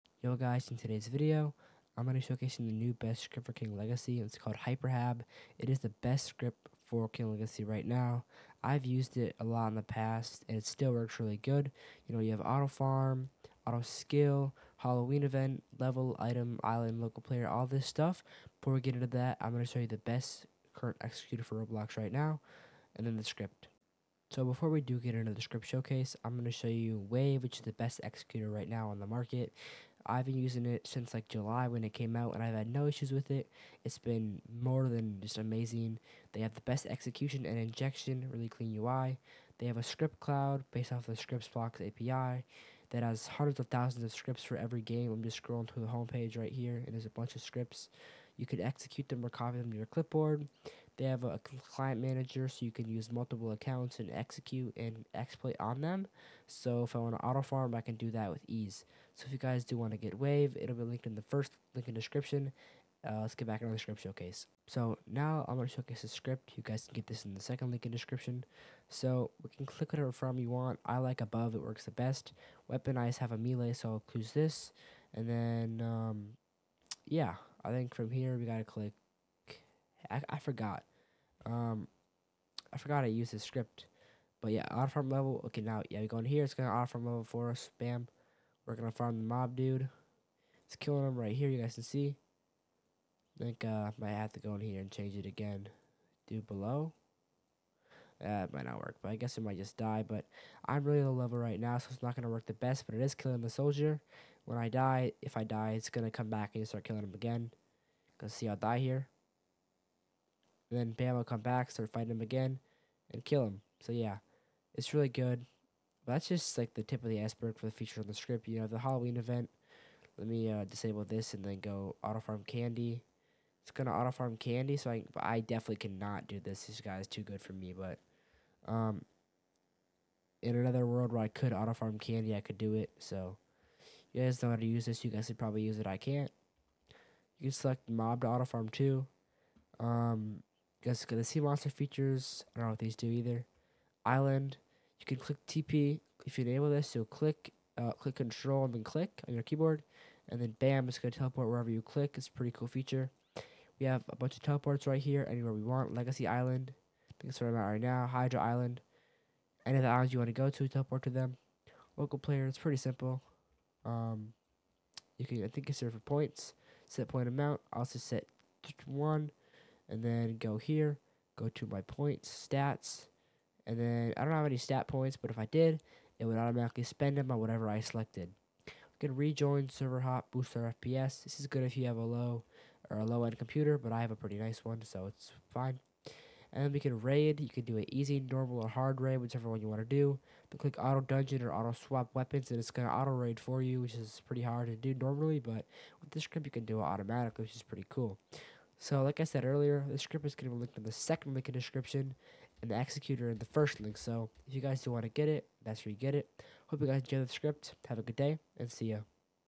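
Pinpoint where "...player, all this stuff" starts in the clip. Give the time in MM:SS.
00:17.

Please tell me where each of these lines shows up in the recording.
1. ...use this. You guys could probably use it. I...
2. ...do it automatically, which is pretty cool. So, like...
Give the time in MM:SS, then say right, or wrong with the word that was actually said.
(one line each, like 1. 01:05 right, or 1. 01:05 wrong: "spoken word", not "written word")
1. 02:14 right
2. 03:16 right.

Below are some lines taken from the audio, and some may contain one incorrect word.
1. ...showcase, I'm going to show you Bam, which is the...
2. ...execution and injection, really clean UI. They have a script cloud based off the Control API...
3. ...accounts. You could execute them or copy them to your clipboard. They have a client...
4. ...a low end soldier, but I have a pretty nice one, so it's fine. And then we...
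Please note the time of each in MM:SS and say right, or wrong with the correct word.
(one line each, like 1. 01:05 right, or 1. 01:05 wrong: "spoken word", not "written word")
1. 00:25 wrong: "Wave", not "Bam"
2. 00:36 wrong: "ScriptBlox", not "Control"
3. 00:47 wrong: "scripts", not "accounts"
4. 03:02 wrong: "computer", not "soldier".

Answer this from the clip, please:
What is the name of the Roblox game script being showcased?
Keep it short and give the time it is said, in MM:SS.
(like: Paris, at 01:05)
Hyperhab, at 00:04.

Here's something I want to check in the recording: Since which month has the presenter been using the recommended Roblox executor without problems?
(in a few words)
July.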